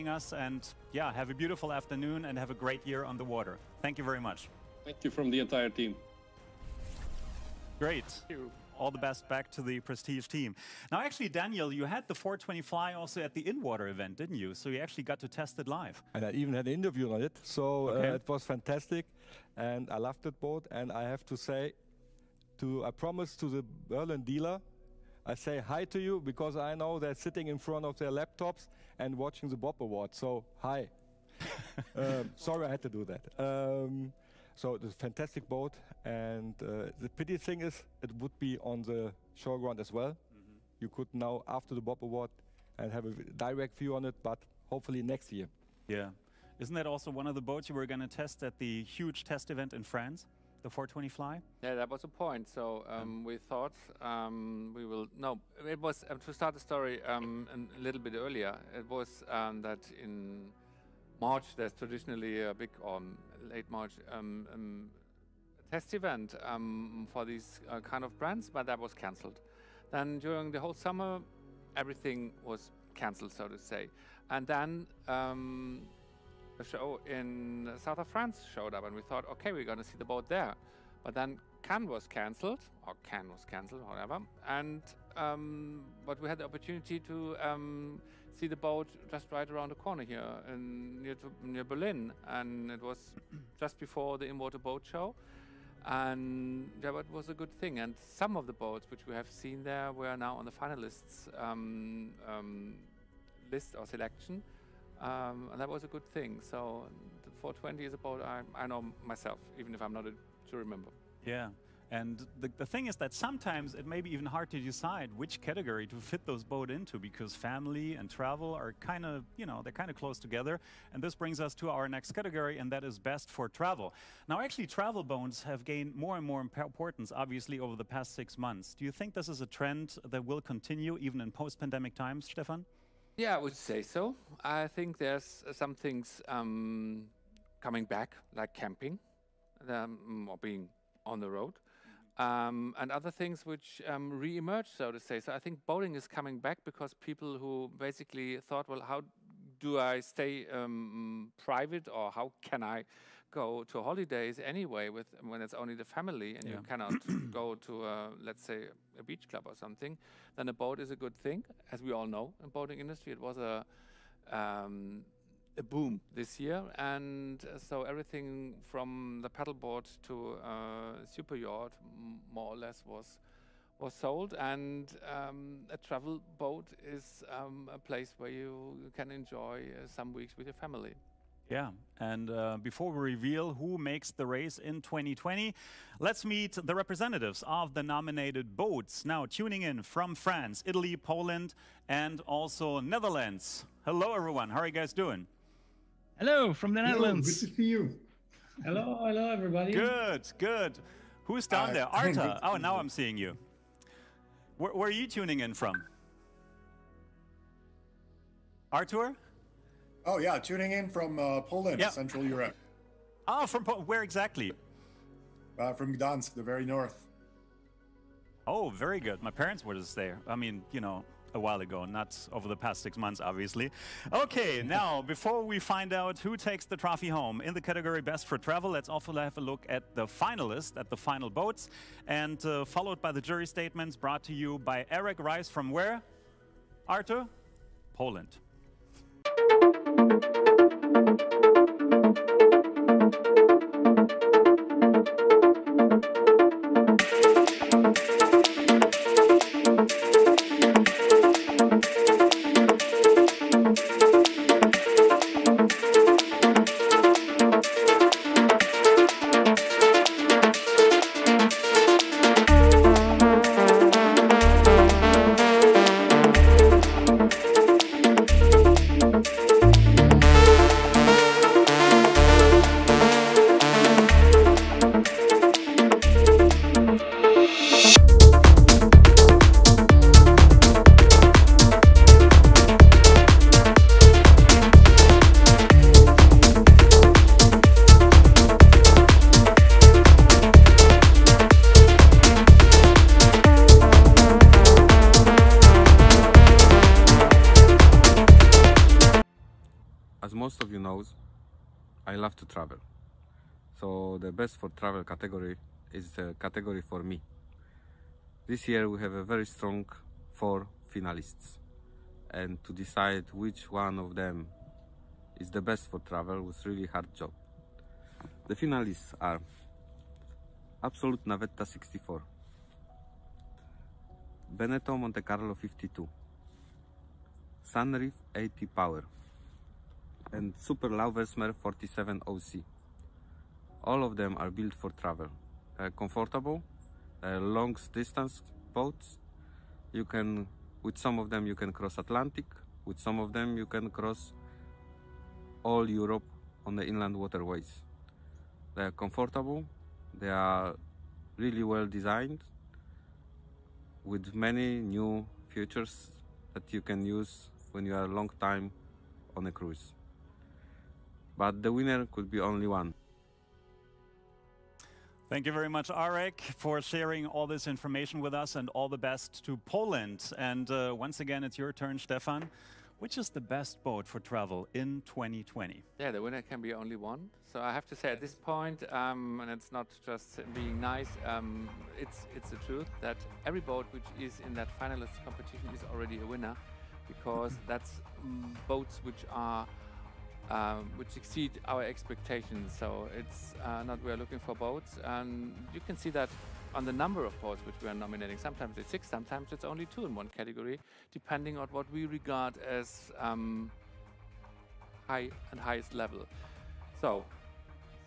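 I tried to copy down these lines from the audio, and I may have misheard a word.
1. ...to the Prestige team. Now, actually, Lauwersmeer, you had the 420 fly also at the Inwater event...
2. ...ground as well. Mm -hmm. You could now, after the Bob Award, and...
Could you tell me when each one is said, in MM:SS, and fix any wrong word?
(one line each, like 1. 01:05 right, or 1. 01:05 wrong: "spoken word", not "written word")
1. 00:09 wrong: "Daniel", not "Lauwersmeer"
2. 00:39 right.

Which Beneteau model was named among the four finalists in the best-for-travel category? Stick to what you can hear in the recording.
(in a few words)
Monte Carlo 52.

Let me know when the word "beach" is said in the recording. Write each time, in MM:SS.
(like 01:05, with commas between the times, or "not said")
02:39.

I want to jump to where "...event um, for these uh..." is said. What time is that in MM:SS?
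01:05.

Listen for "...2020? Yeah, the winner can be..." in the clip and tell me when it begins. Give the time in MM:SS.
06:15.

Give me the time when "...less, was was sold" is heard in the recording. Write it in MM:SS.
02:52.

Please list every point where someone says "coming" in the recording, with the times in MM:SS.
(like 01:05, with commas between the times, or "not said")
02:17, 02:26.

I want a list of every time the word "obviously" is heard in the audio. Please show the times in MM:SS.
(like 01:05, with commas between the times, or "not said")
02:07, 03:43.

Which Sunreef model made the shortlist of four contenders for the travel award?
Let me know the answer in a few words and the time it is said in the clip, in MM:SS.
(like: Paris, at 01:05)
Sunreef 80 Power, at 05:27.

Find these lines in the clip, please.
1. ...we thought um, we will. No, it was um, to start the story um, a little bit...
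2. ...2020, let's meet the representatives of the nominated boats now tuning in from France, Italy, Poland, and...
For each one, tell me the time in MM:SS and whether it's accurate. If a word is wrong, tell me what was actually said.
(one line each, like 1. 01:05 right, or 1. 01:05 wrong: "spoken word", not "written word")
1. 00:53 right
2. 03:04 right.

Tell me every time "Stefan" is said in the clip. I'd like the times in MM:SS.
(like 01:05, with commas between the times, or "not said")
02:12, 06:11.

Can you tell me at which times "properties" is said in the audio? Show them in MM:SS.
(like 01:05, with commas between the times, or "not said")
not said.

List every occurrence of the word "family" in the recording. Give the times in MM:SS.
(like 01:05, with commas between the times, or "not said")
01:57, 02:35, 03:00.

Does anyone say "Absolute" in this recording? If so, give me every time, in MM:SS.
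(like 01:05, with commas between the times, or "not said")
05:20.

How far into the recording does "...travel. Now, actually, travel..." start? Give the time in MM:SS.
02:03.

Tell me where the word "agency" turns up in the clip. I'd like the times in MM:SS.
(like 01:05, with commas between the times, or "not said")
not said.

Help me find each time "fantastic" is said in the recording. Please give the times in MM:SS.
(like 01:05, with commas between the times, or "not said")
00:18, 00:34.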